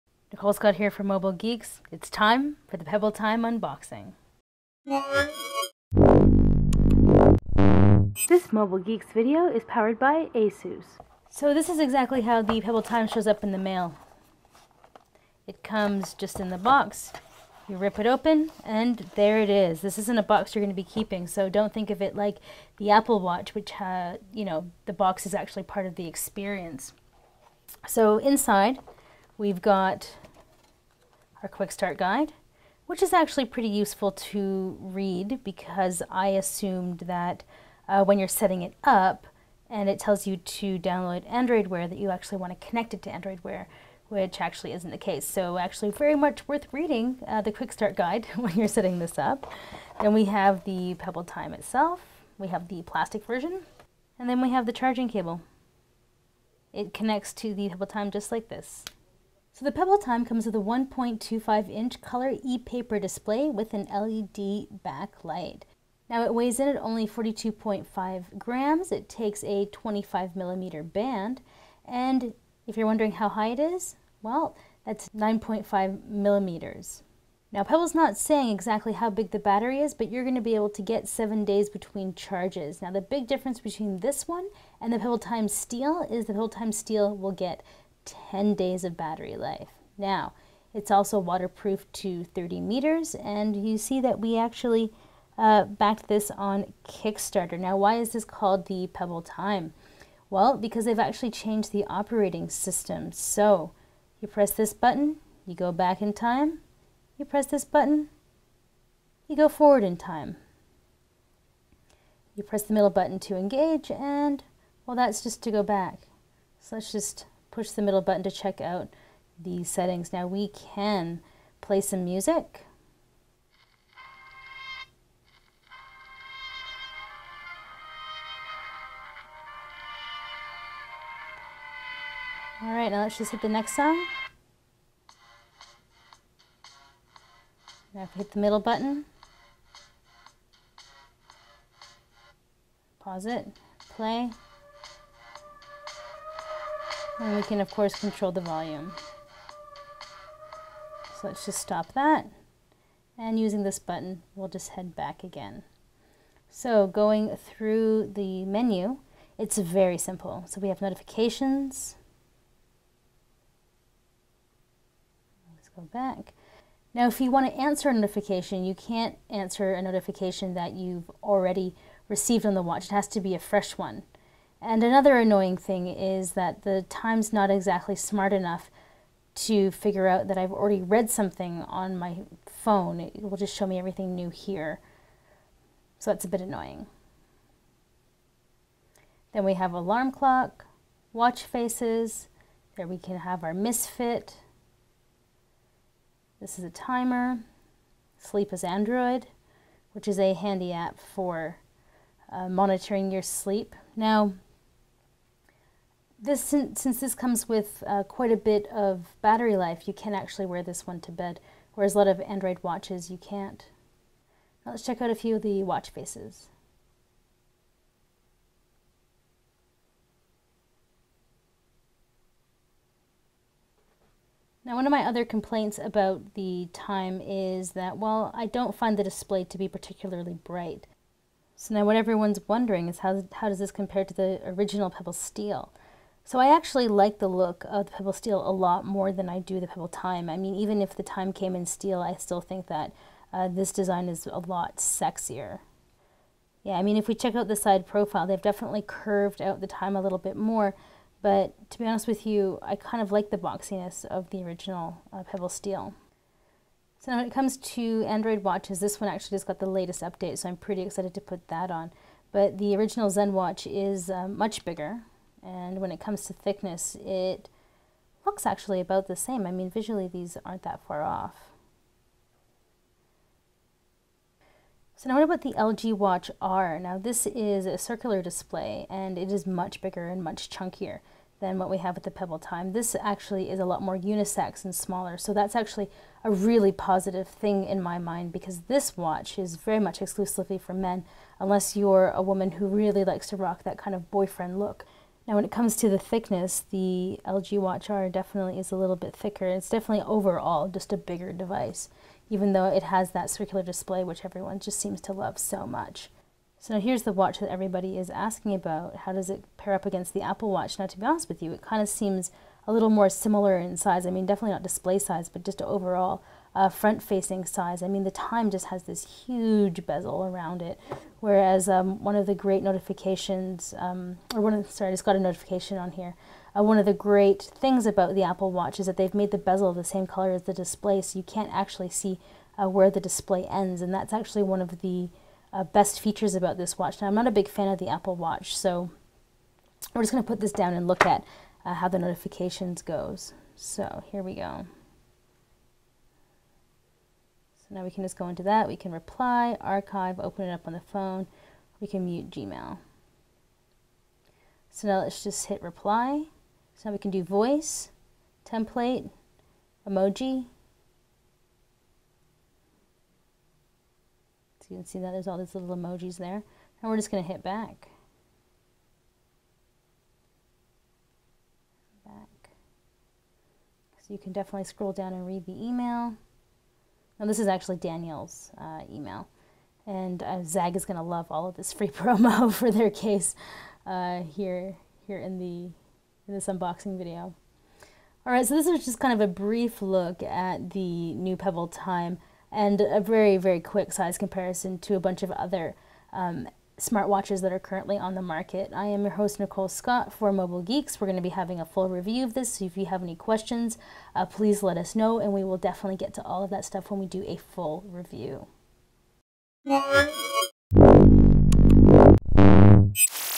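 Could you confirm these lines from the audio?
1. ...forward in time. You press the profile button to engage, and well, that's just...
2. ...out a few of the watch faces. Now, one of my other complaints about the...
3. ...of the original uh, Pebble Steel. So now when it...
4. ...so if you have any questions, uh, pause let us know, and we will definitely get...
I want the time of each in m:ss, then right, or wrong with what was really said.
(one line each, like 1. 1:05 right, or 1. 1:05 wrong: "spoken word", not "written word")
1. 1:49 wrong: "middle", not "profile"
2. 3:35 right
3. 4:14 right
4. 6:42 wrong: "please", not "pause".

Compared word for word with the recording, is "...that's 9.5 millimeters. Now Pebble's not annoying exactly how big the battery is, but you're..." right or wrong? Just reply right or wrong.
wrong.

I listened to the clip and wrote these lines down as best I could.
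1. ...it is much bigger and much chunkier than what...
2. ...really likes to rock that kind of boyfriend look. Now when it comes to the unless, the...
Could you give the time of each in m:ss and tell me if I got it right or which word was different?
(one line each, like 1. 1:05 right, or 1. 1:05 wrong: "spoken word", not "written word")
1. 4:39 right
2. 4:52 wrong: "thickness", not "unless".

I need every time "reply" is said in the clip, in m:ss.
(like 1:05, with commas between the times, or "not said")
5:48, 5:55.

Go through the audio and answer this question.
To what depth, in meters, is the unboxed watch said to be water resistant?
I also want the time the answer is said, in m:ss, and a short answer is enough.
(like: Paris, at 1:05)
30 meters, at 1:32.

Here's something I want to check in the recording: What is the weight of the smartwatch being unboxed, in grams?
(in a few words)
42.5 grams.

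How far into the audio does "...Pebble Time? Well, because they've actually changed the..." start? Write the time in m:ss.
1:38.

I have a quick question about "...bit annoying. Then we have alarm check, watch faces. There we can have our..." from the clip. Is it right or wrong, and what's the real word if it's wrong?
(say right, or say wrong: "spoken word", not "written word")
wrong: "clock", not "check".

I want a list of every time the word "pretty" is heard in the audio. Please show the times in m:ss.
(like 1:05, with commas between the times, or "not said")
0:33, 4:20.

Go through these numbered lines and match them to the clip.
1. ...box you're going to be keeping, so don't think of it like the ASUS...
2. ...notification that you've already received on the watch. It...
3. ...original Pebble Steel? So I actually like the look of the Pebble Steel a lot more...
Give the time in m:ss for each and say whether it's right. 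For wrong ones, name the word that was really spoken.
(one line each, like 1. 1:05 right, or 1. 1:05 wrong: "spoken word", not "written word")
1. 0:20 wrong: "Apple", not "ASUS"
2. 2:49 right
3. 3:54 right.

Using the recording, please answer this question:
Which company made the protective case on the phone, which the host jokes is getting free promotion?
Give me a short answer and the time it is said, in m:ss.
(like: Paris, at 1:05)
Zagg, at 6:20.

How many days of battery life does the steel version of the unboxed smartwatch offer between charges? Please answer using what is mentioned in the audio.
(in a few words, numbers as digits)
10 days.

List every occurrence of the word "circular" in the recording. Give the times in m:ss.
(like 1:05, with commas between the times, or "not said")
4:37, 5:03.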